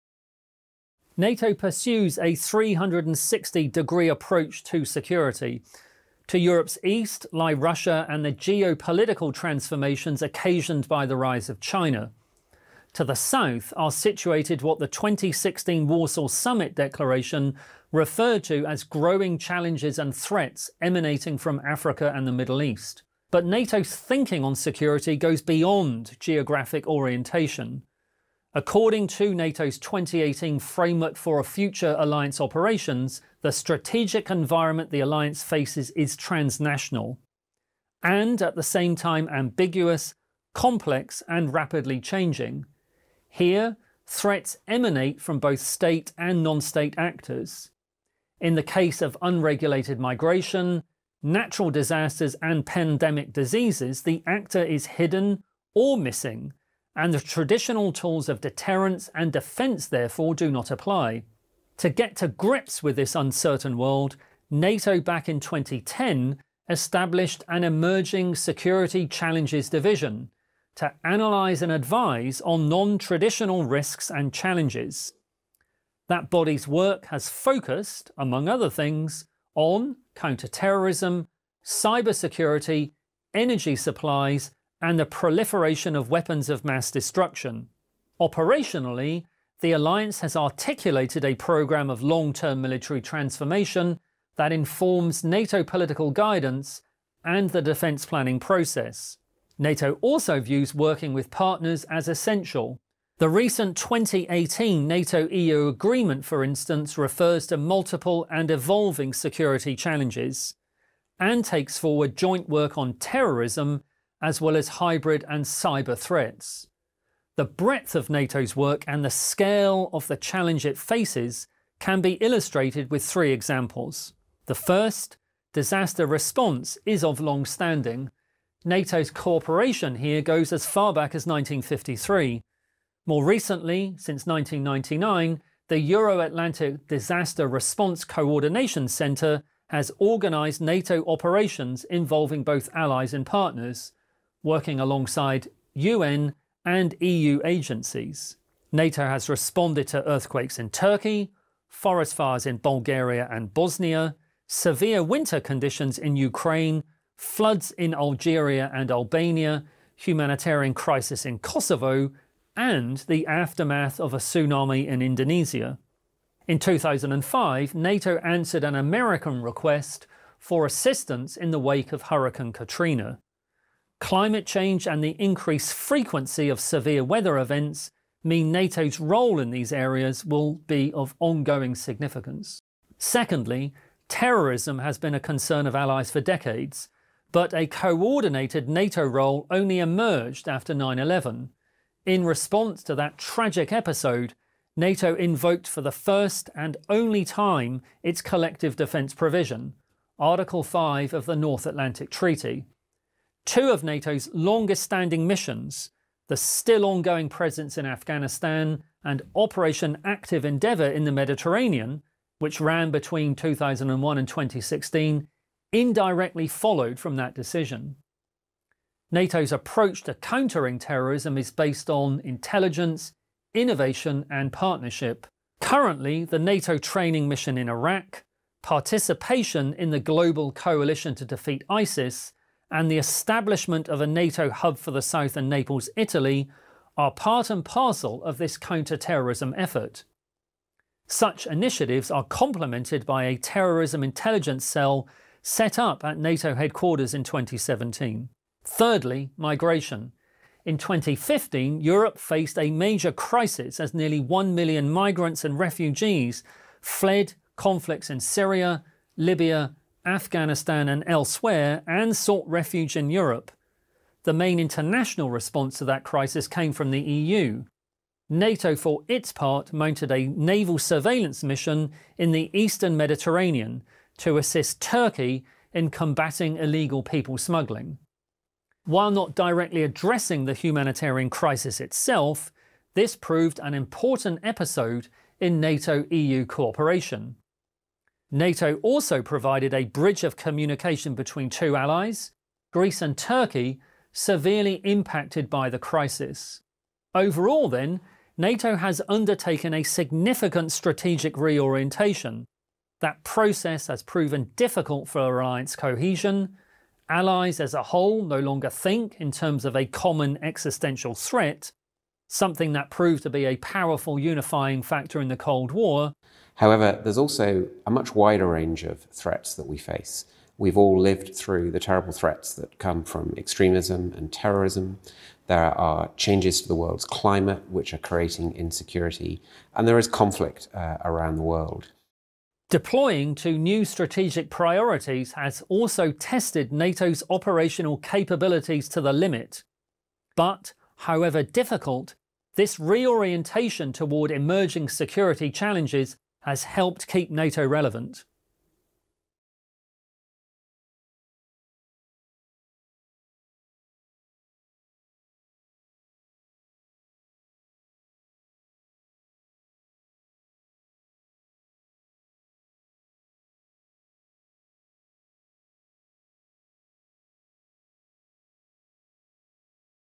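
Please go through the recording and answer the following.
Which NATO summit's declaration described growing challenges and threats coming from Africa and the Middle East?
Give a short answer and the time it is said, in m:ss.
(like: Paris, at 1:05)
2016 Warsaw Summit, at 0:14.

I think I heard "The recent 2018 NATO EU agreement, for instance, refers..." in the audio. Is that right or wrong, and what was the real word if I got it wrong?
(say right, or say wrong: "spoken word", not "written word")
right.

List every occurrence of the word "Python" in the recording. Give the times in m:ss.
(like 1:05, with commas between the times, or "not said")
not said.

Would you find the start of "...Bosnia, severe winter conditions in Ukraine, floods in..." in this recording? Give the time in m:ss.
2:33.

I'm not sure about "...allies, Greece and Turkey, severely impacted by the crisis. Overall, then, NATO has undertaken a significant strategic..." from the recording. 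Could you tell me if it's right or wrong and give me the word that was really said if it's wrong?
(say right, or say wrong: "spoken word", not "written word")
right.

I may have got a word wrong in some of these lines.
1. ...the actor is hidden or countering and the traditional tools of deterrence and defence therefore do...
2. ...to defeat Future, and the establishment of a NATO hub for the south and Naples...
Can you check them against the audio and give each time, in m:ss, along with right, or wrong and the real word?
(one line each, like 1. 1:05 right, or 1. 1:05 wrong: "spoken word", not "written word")
1. 0:54 wrong: "missing", not "countering"
2. 3:51 wrong: "ISIS", not "Future".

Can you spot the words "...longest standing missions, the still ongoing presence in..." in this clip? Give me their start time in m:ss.
3:24.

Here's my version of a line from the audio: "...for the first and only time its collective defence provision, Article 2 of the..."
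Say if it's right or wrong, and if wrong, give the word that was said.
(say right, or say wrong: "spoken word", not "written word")
wrong: "5", not "2".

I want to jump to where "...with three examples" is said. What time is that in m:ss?
2:02.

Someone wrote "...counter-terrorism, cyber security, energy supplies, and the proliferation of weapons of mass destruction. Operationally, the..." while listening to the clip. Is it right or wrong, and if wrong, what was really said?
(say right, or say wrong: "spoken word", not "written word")
right.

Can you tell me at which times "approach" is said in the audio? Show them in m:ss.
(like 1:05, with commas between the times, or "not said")
0:04, 3:39.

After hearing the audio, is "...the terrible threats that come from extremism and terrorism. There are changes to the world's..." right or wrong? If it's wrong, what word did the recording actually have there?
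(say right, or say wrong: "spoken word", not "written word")
right.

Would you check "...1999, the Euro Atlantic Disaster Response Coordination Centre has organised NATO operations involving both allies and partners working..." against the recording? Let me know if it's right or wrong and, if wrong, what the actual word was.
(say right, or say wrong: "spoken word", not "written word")
right.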